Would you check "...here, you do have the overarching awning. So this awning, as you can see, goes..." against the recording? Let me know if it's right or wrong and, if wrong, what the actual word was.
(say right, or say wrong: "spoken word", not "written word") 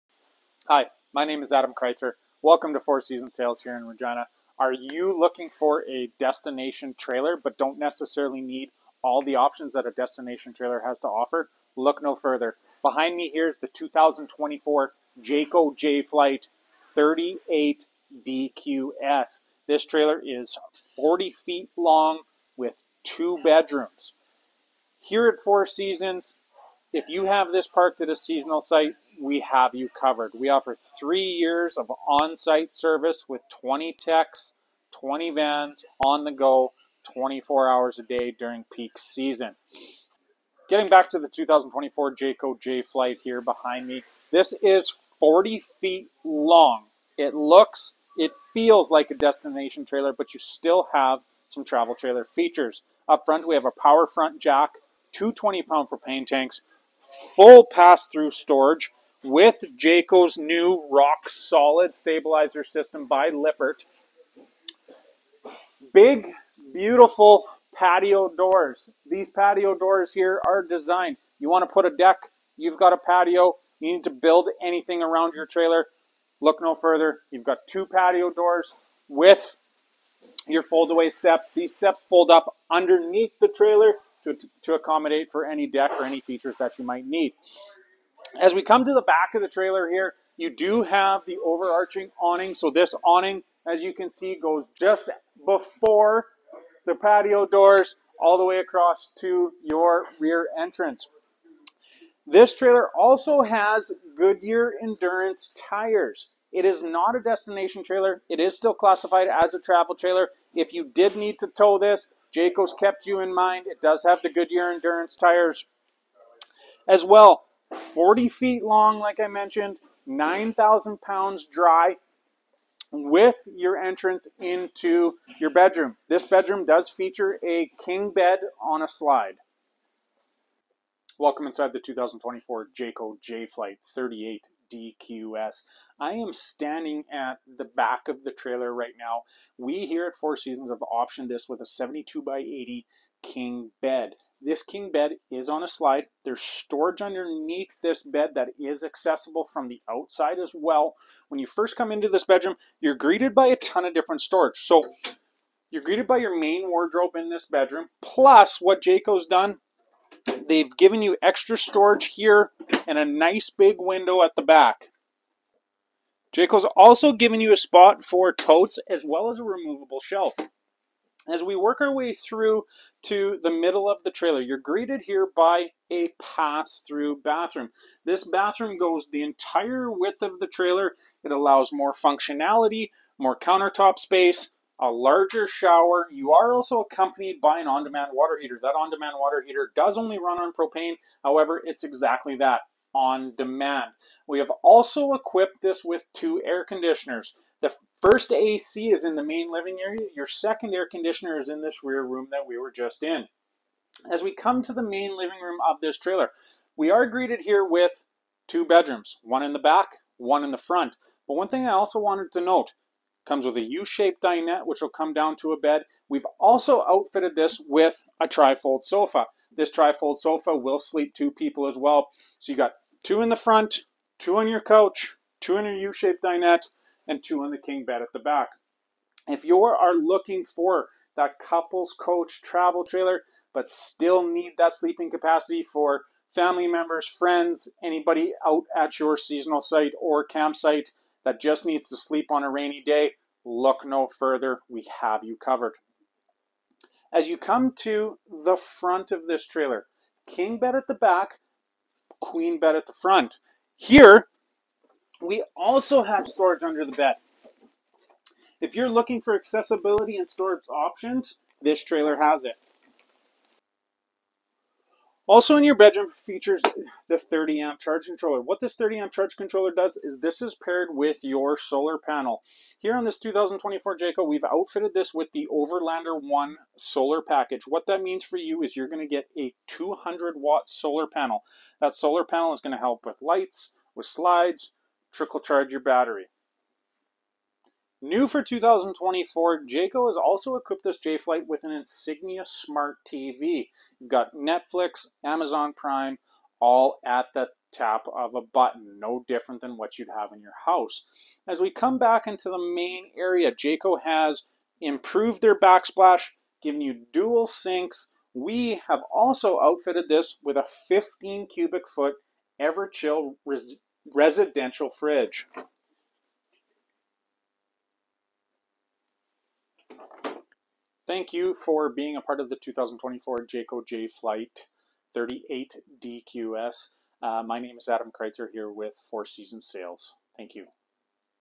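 right.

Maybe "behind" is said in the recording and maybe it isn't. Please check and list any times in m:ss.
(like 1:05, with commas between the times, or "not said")
0:12, 0:43.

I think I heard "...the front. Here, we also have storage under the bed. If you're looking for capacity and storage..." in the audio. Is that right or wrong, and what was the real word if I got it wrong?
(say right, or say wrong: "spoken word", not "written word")
wrong: "accessibility", not "capacity".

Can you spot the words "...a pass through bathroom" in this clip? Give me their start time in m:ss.
2:55.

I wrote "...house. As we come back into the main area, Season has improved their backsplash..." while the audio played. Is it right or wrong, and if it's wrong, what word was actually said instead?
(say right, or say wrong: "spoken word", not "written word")
wrong: "Jayco", not "Season".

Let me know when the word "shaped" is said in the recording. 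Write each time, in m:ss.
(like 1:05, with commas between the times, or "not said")
3:33, 3:45.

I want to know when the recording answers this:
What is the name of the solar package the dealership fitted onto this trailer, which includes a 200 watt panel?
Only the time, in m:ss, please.
4:35.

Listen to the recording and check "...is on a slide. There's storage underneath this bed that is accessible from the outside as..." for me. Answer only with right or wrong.
right.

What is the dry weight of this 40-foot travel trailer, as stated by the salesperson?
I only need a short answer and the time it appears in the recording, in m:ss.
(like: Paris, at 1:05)
9,000 pounds, at 2:00.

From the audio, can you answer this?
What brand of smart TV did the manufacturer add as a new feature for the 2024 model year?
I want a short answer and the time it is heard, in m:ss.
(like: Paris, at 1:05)
Insignia, at 4:51.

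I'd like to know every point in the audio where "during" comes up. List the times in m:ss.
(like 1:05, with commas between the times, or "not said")
0:38.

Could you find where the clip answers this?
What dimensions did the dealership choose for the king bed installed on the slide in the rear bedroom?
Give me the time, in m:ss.
2:21.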